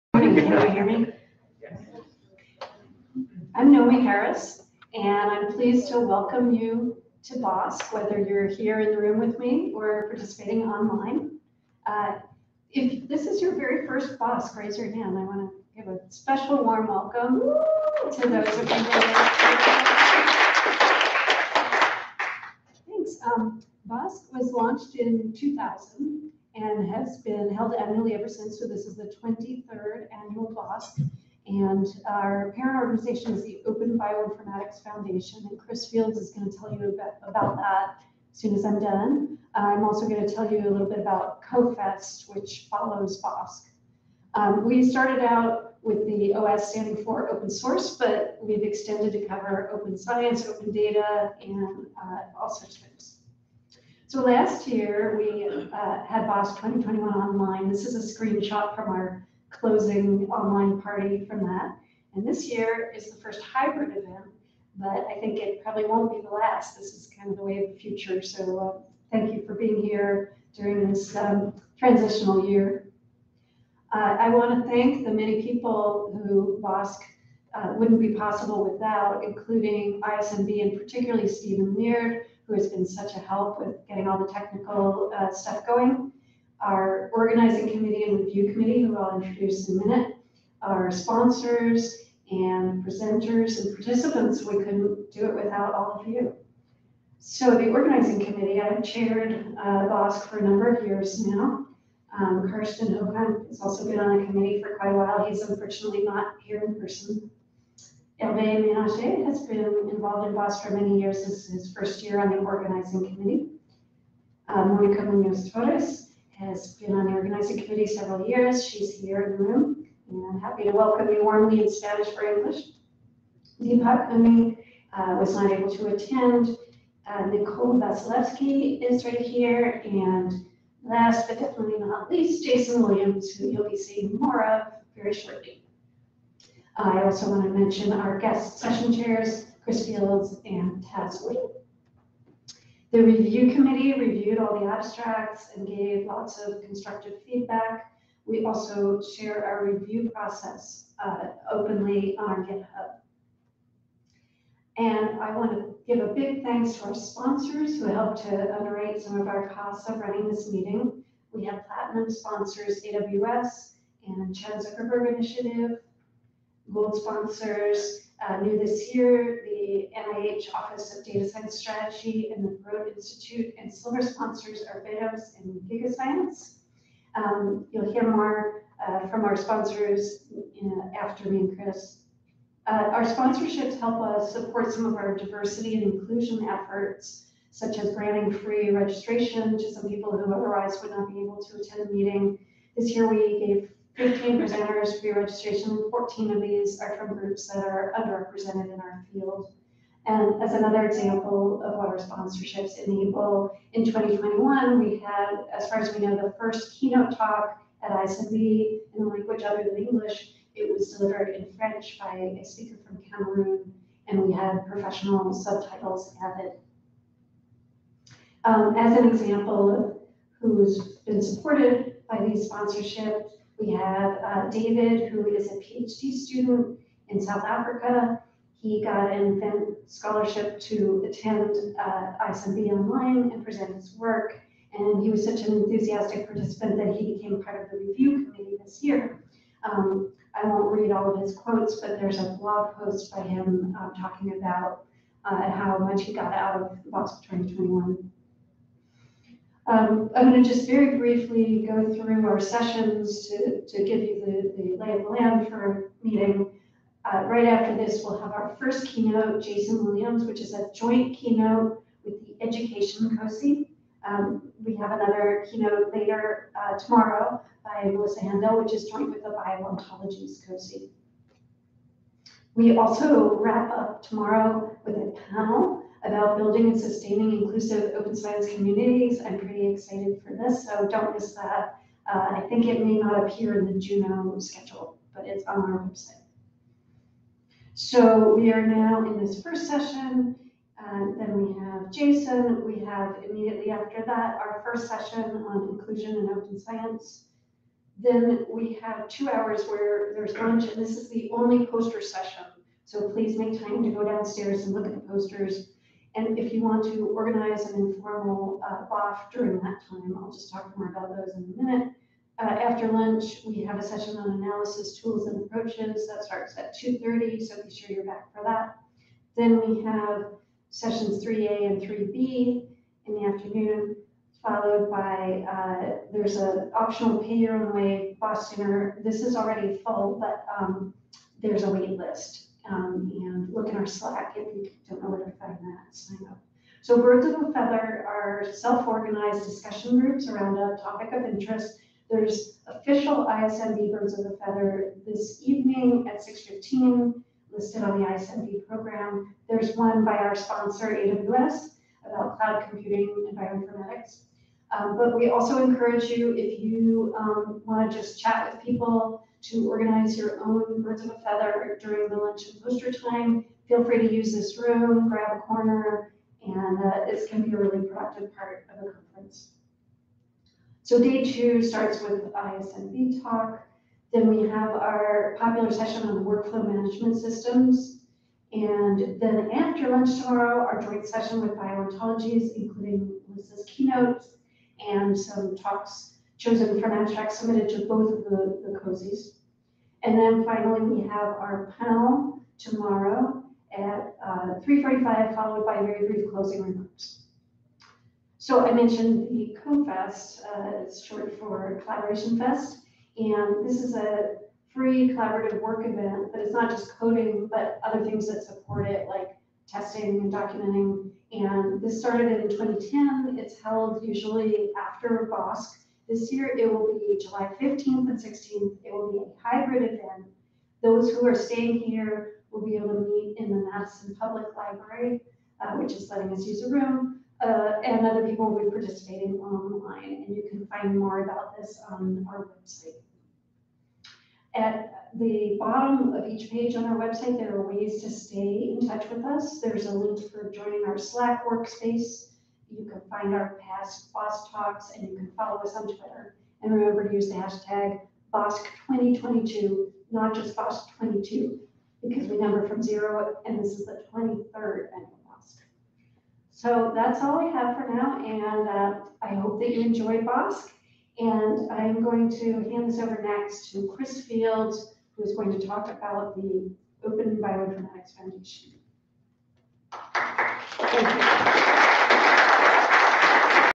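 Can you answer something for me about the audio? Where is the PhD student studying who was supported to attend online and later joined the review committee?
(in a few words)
South Africa.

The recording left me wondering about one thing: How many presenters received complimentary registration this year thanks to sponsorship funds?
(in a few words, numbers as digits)
15.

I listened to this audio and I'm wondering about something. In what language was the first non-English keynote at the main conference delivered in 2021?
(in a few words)
French.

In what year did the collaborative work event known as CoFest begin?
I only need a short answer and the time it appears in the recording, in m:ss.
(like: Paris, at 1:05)
2010, at 6:52.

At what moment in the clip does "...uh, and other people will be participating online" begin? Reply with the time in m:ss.
7:07.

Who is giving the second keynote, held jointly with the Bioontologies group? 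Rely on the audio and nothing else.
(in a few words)
Melissa Haendel.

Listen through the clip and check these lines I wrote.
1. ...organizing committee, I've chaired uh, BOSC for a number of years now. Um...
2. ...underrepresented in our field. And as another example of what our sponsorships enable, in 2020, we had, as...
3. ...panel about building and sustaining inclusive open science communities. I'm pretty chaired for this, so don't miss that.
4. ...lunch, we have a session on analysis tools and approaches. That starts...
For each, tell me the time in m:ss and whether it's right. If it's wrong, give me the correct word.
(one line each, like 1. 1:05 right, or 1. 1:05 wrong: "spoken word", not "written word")
1. 1:37 right
2. 3:17 wrong: "2021", not "2020"
3. 4:35 wrong: "excited", not "chaired"
4. 5:12 right.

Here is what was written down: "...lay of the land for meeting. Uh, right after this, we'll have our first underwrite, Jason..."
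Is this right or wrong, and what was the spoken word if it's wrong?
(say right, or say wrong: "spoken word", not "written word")
wrong: "keynote", not "underwrite".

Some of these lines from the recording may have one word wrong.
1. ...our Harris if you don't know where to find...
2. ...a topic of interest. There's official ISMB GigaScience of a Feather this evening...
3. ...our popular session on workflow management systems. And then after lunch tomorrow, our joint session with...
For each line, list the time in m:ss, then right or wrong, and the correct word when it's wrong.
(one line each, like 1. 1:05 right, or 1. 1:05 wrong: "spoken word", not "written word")
1. 5:33 wrong: "Slack", not "Harris"
2. 5:40 wrong: "Birds", not "GigaScience"
3. 6:14 right.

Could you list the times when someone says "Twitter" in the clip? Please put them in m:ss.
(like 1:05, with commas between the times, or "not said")
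7:25.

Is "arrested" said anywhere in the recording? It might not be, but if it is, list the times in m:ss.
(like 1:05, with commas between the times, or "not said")
not said.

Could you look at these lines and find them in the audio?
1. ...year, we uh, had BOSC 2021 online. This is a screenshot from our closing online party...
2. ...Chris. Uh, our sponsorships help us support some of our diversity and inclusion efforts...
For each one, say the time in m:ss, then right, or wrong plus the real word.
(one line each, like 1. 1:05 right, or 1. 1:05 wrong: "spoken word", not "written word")
1. 0:54 right
2. 3:01 right.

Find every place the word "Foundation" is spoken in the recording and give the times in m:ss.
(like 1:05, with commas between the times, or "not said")
0:34, 7:48.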